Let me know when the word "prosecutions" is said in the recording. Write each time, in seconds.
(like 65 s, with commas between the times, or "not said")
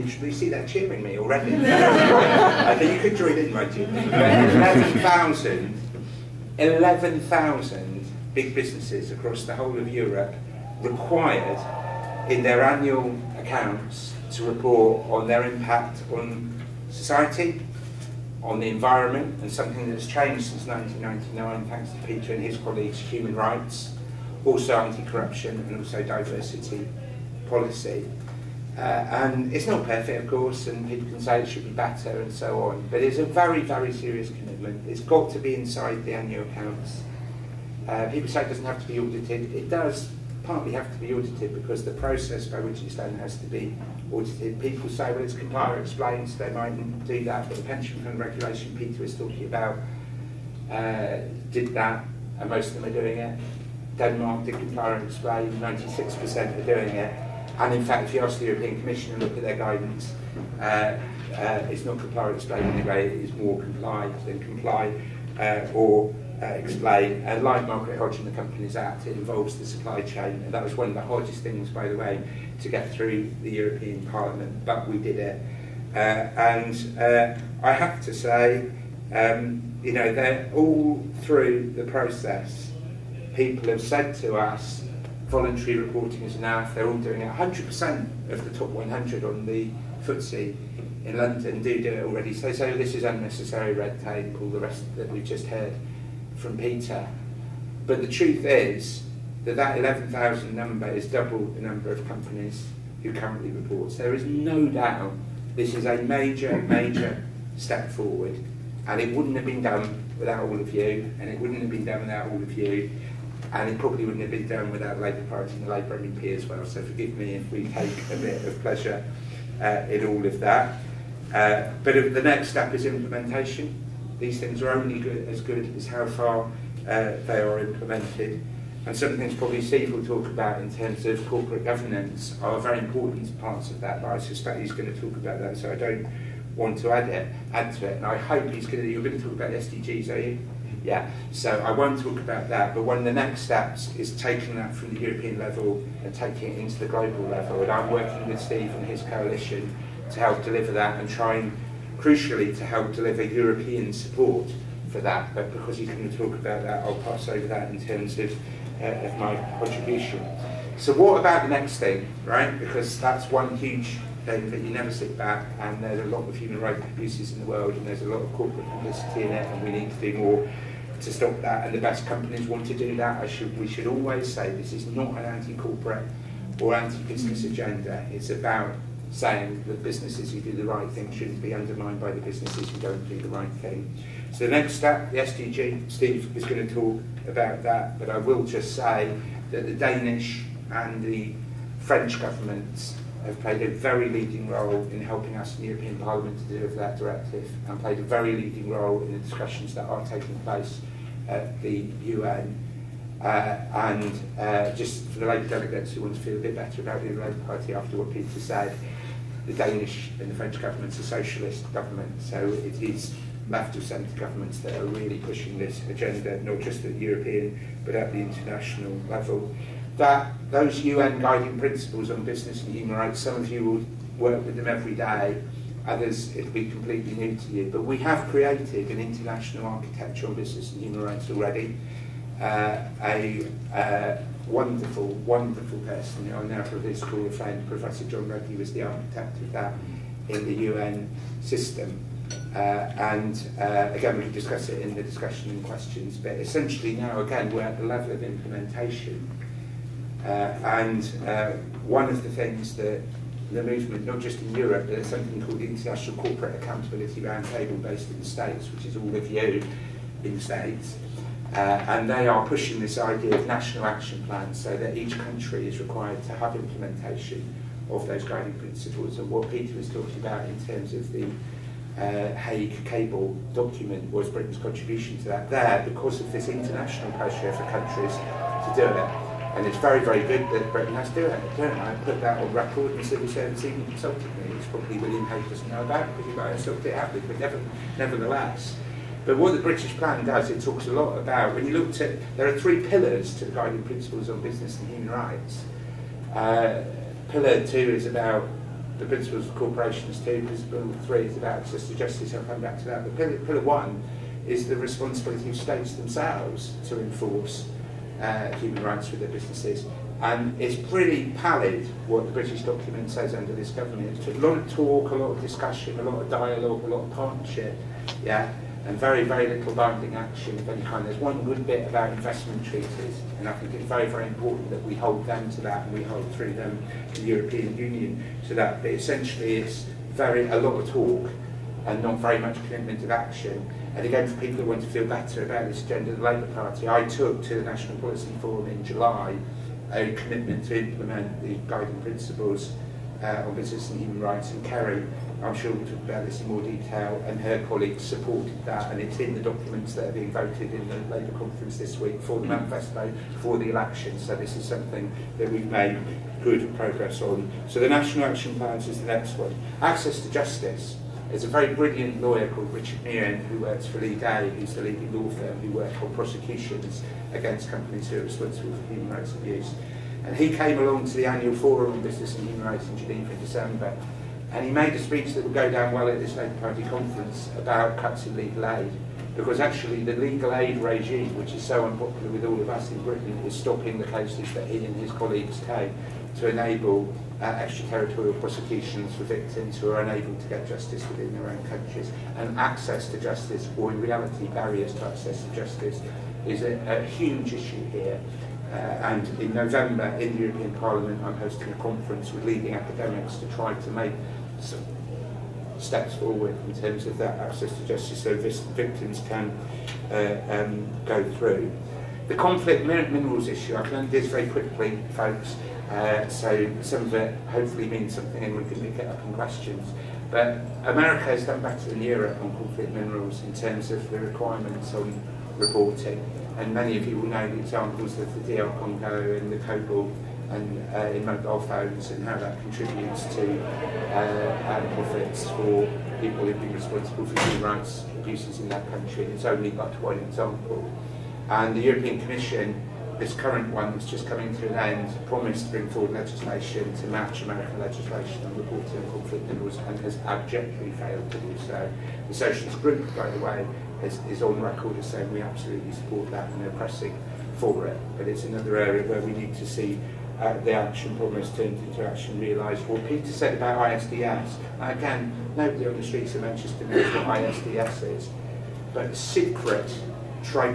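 366 s, 388 s.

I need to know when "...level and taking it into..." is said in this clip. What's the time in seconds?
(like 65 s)
145 s.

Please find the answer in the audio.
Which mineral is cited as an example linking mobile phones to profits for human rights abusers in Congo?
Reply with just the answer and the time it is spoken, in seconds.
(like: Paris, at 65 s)
cobalt, at 429 s.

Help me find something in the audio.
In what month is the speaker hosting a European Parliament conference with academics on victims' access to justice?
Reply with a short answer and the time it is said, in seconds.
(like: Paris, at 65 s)
November, at 399 s.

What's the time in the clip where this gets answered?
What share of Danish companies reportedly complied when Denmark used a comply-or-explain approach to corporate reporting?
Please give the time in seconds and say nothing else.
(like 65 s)
55 s.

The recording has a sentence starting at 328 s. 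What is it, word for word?
But essentially, it's very a lot of talk and not very much commitment of action.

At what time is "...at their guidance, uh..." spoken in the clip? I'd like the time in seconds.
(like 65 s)
59 s.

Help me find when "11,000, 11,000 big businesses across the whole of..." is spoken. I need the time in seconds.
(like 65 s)
3 s.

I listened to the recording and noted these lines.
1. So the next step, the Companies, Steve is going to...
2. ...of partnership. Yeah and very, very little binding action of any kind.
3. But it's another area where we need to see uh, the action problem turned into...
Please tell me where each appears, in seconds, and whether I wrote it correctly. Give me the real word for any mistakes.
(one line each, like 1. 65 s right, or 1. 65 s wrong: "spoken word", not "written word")
1. 184 s wrong: "SDG", not "Companies"
2. 317 s right
3. 458 s right.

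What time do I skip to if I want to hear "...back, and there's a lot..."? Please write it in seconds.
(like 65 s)
165 s.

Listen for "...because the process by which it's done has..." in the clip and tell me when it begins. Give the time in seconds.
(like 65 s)
41 s.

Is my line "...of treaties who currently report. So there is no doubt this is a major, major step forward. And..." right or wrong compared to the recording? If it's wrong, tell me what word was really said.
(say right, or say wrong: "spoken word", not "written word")
wrong: "companies", not "treaties".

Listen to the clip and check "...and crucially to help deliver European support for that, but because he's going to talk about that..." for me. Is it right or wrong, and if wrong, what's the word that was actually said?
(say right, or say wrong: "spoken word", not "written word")
right.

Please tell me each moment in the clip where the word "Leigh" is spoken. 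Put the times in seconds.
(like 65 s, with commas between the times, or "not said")
363 s.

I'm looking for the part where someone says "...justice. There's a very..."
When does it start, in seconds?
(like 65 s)
360 s.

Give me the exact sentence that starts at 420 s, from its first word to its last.
But America has done better than Europe on conflict minerals in terms of the requirements on reporting.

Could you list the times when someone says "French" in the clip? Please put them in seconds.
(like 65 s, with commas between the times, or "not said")
191 s, 210 s.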